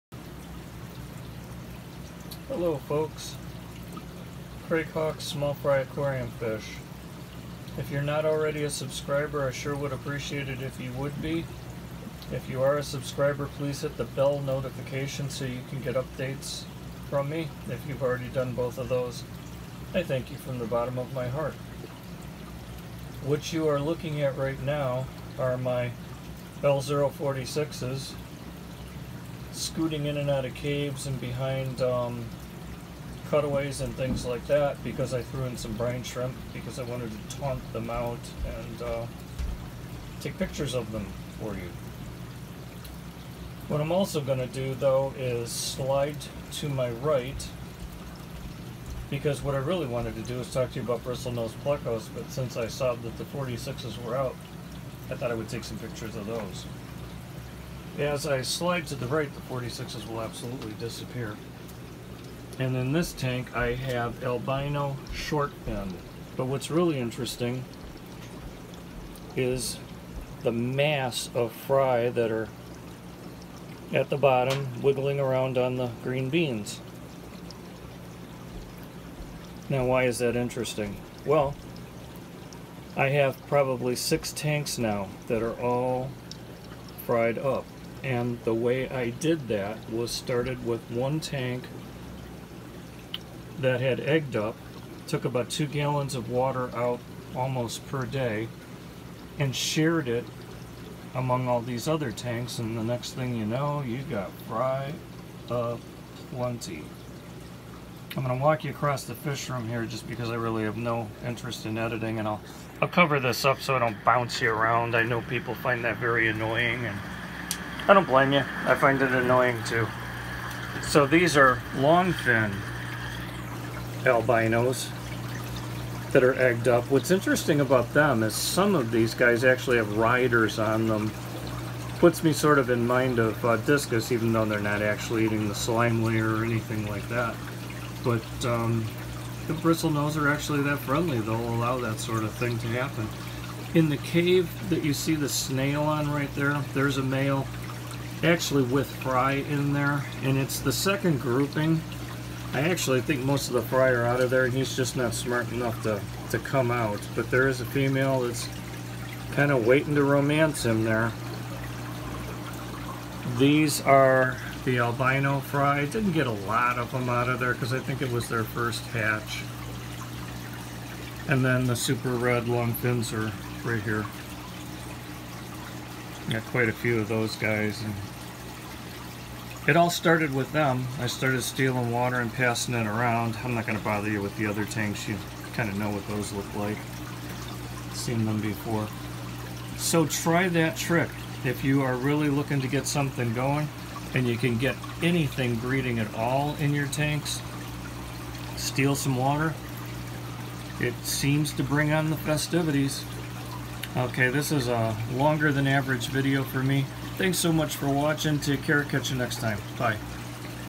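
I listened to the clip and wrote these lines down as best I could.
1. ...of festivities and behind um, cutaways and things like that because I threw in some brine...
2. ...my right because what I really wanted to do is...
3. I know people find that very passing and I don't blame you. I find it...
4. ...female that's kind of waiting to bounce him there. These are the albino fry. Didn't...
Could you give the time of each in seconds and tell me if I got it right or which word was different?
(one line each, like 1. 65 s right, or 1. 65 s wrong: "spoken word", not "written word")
1. 30 s wrong: "caves", not "festivities"
2. 46 s right
3. 114 s wrong: "annoying", not "passing"
4. 157 s wrong: "romance", not "bounce".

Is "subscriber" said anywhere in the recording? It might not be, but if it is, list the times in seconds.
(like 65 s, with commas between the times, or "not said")
8 s, 12 s.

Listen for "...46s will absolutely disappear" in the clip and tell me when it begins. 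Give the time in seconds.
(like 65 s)
59 s.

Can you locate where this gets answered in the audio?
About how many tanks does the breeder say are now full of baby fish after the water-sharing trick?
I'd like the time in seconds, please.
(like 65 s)
83 s.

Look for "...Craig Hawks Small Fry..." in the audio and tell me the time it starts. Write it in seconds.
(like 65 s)
4 s.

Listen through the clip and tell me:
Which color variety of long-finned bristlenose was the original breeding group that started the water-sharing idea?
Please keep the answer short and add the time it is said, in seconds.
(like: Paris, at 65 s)
super red, at 171 s.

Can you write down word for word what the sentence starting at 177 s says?
And it all started with them.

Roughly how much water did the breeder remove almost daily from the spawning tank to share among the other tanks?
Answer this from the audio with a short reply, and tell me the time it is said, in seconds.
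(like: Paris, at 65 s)
2 gallons, at 95 s.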